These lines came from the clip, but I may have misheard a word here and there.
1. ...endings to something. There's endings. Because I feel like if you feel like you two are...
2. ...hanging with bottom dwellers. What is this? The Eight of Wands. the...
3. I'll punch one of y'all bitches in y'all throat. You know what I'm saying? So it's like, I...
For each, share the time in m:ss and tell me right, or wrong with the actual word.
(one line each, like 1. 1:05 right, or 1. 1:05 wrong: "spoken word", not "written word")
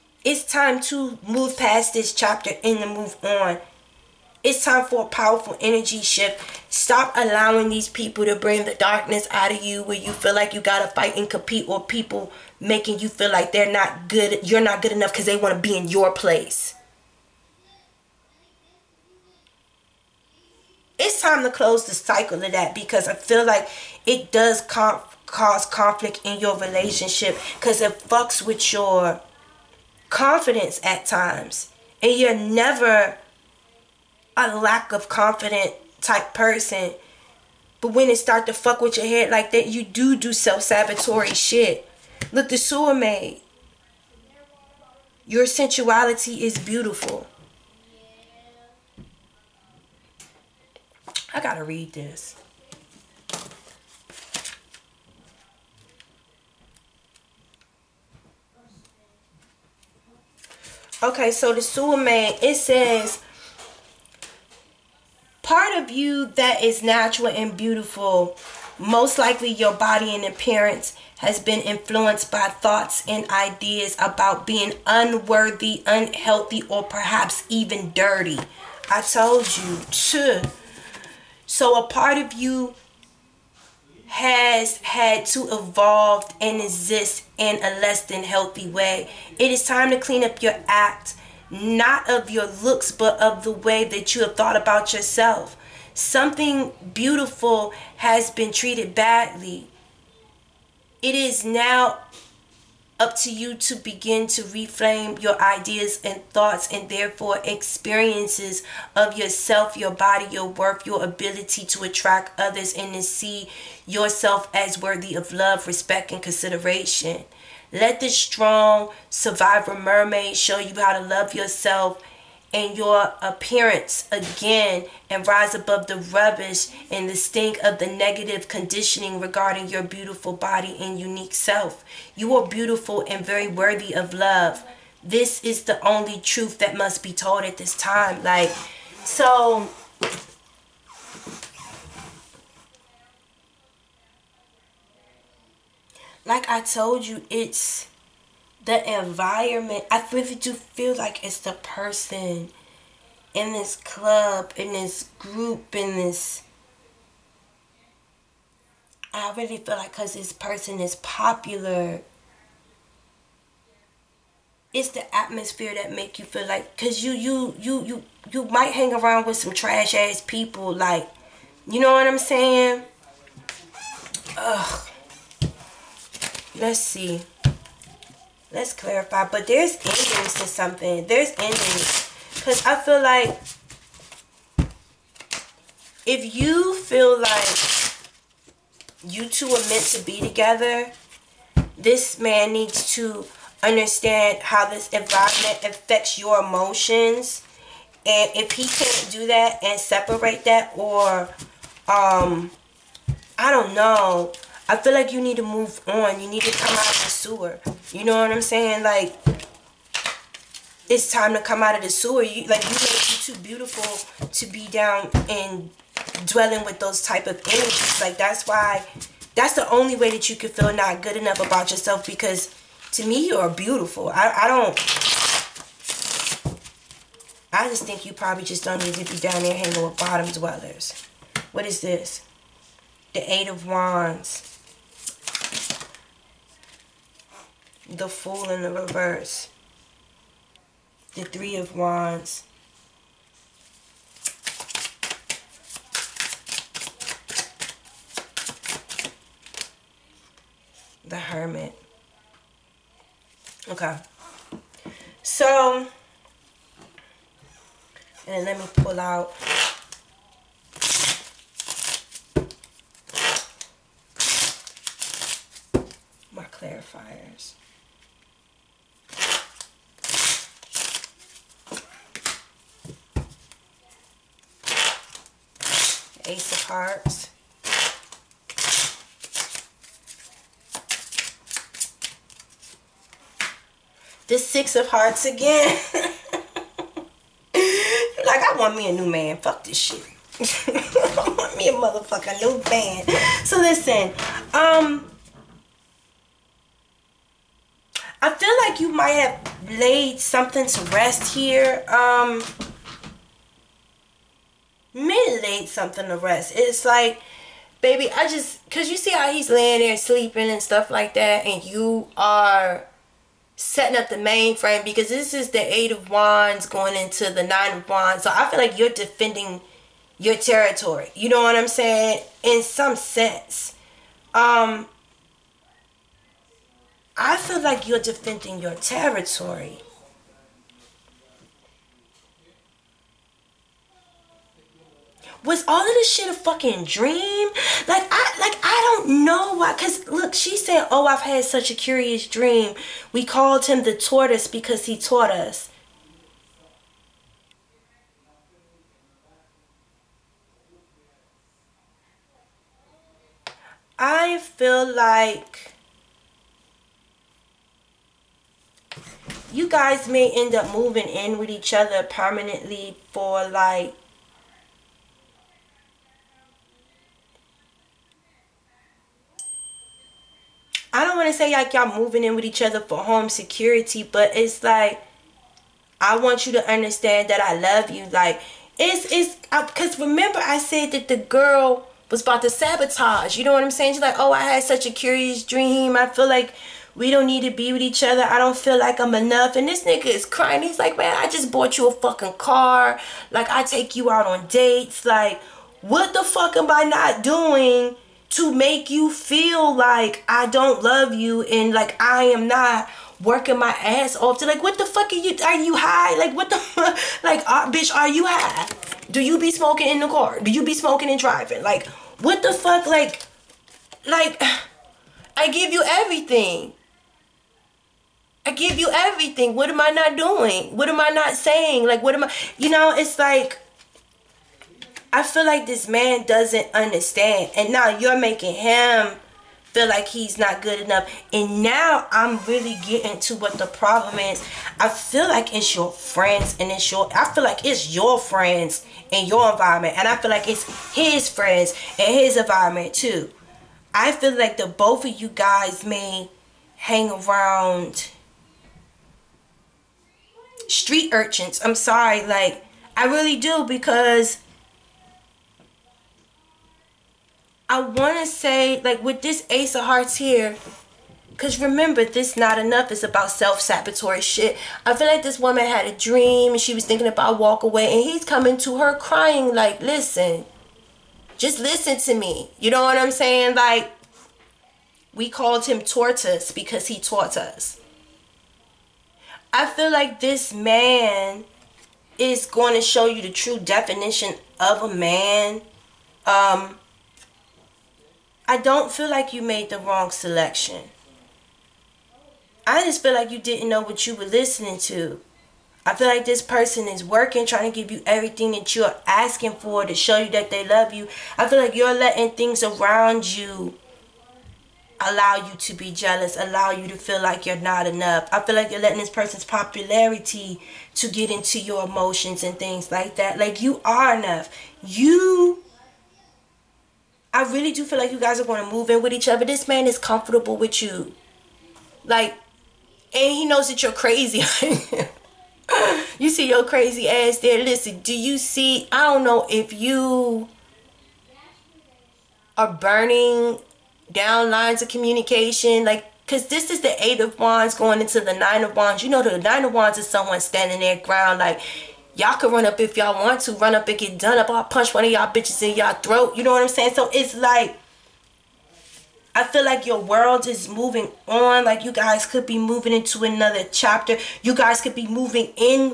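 1. 2:59 right
2. 3:49 right
3. 9:04 right.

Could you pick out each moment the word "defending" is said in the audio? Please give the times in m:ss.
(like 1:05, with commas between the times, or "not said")
5:18, 5:27.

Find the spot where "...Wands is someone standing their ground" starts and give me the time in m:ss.
8:59.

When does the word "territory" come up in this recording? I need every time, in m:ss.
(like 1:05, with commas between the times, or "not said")
5:20, 5:28.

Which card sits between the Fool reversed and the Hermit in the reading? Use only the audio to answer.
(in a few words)
Three of Wands.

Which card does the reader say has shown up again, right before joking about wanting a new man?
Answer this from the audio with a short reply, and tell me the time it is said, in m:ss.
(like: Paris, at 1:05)
Six of Hearts, at 4:44.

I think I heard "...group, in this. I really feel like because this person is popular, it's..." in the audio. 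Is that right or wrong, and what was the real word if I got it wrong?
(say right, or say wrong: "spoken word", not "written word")
right.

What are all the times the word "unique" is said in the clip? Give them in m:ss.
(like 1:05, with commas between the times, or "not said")
2:10.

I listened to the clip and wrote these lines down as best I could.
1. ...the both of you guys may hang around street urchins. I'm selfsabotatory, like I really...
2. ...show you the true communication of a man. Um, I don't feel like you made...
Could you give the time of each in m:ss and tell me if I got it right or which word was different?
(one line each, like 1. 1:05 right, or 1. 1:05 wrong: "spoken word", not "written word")
1. 7:24 wrong: "sorry", not "selfsabotatory"
2. 8:02 wrong: "definition", not "communication".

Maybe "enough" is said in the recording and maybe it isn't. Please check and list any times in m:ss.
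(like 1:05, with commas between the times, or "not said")
0:14, 3:41, 6:29, 7:10, 7:42, 8:27, 8:34.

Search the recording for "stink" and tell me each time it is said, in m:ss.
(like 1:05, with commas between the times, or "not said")
2:07.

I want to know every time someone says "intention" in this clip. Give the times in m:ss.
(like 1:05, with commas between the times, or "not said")
not said.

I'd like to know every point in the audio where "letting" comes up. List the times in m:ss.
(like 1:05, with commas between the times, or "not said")
8:21, 8:28.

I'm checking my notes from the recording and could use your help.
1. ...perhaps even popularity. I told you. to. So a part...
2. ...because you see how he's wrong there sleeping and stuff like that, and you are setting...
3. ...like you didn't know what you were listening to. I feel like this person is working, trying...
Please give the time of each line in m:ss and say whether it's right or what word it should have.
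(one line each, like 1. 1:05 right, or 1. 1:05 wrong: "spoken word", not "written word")
1. 1:16 wrong: "dirty", not "popularity"
2. 5:08 wrong: "laying", not "wrong"
3. 8:13 right.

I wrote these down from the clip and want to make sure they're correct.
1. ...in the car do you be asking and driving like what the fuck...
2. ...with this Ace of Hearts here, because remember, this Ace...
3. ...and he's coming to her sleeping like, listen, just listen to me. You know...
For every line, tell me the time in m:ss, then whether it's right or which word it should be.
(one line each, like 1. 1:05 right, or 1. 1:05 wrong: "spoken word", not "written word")
1. 6:49 wrong: "smoking", not "asking"
2. 7:39 wrong: "Not", not "Ace"
3. 7:47 wrong: "crying", not "sleeping".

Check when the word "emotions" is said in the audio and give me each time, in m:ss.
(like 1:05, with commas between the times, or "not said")
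3:16, 8:31.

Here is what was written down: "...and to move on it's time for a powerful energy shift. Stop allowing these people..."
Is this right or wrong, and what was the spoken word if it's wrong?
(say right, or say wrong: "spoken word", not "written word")
right.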